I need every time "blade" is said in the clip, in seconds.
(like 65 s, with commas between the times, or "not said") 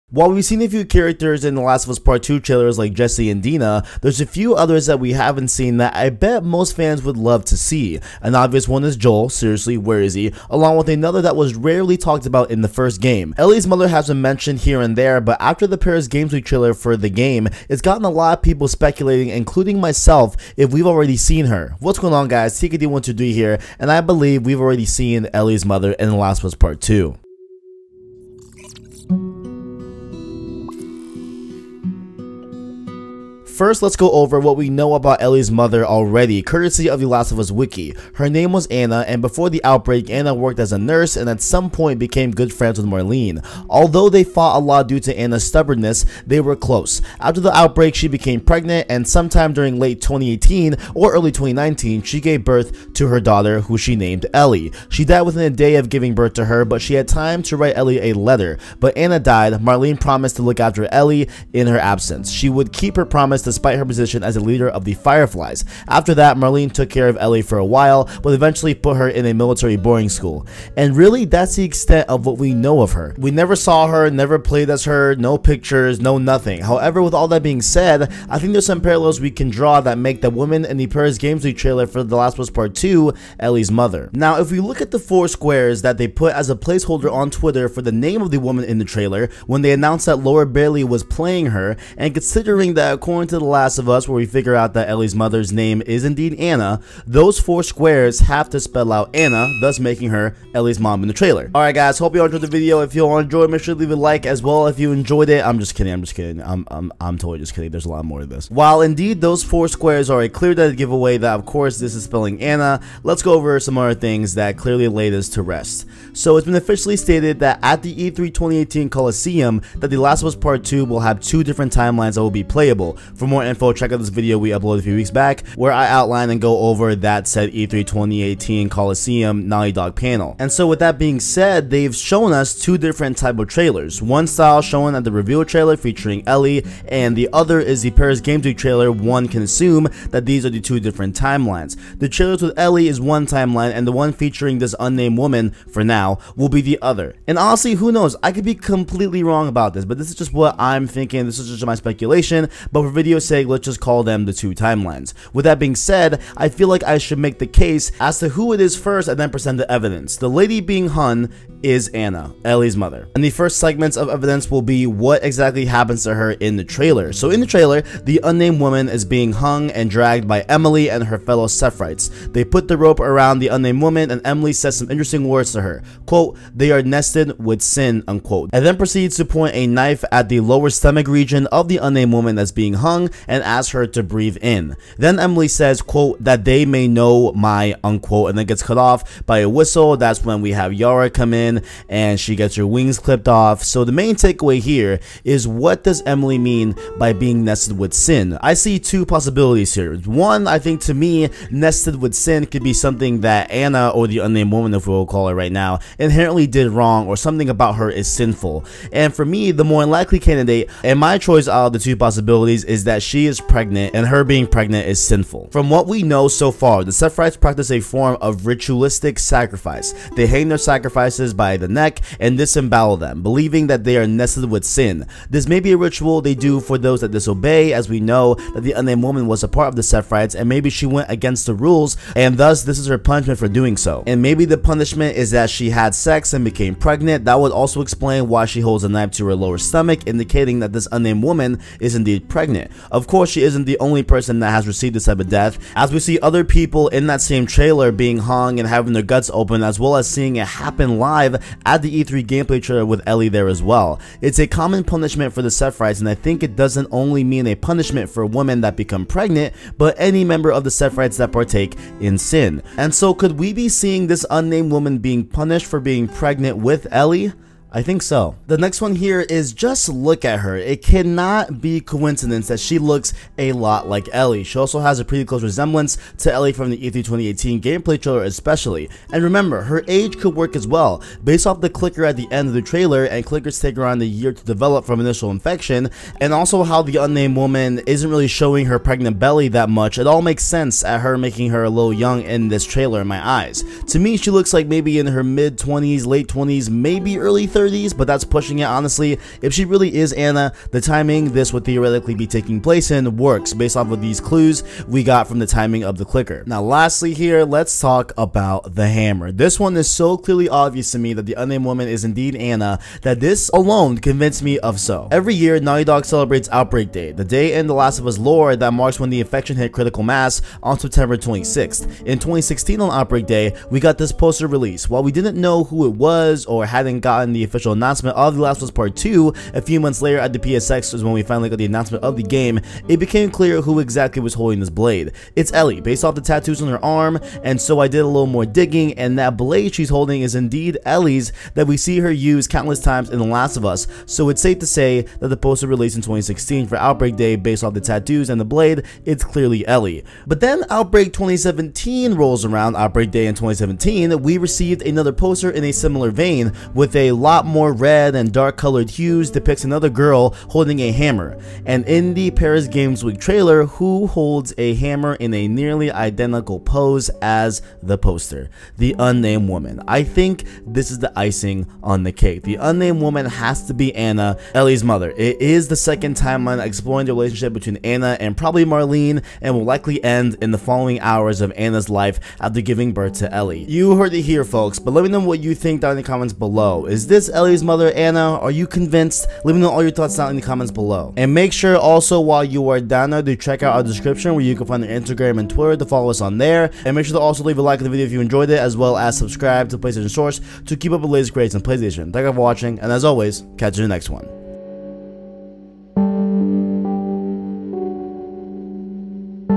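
334 s, 339 s, 348 s.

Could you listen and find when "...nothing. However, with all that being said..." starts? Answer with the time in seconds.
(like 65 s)
76 s.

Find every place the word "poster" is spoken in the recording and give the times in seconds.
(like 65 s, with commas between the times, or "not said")
324 s, 345 s, 355 s, 367 s.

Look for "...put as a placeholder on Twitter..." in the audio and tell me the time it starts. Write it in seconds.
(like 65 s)
86 s.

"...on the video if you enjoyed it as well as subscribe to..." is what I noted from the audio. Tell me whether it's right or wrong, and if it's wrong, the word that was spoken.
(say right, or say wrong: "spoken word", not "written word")
right.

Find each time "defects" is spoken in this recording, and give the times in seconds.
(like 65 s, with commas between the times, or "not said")
not said.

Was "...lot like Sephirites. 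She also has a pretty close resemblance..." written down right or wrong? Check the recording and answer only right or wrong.
wrong.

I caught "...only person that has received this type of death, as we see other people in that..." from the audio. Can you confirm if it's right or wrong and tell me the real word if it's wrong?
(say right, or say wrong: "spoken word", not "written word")
right.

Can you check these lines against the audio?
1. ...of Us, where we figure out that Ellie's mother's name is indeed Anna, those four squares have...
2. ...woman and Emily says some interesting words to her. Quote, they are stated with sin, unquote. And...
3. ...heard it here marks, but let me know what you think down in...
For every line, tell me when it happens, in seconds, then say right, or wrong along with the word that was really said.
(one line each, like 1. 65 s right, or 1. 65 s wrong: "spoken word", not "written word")
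1. 93 s right
2. 173 s wrong: "nested", not "stated"
3. 383 s wrong: "folks", not "marks".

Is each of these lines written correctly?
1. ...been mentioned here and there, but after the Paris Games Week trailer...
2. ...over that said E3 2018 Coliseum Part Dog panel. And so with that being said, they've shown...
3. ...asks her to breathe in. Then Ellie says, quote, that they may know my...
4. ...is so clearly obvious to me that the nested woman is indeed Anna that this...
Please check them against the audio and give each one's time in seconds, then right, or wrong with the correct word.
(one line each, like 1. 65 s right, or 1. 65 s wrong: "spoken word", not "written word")
1. 14 s right
2. 126 s wrong: "Naughty", not "Part"
3. 183 s wrong: "Emily", not "Ellie"
4. 309 s wrong: "unnamed", not "nested".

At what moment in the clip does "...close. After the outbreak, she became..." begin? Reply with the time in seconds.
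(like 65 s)
46 s.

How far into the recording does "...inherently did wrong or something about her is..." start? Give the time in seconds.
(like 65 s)
205 s.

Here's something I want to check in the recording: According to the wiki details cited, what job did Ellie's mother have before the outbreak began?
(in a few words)
Nurse.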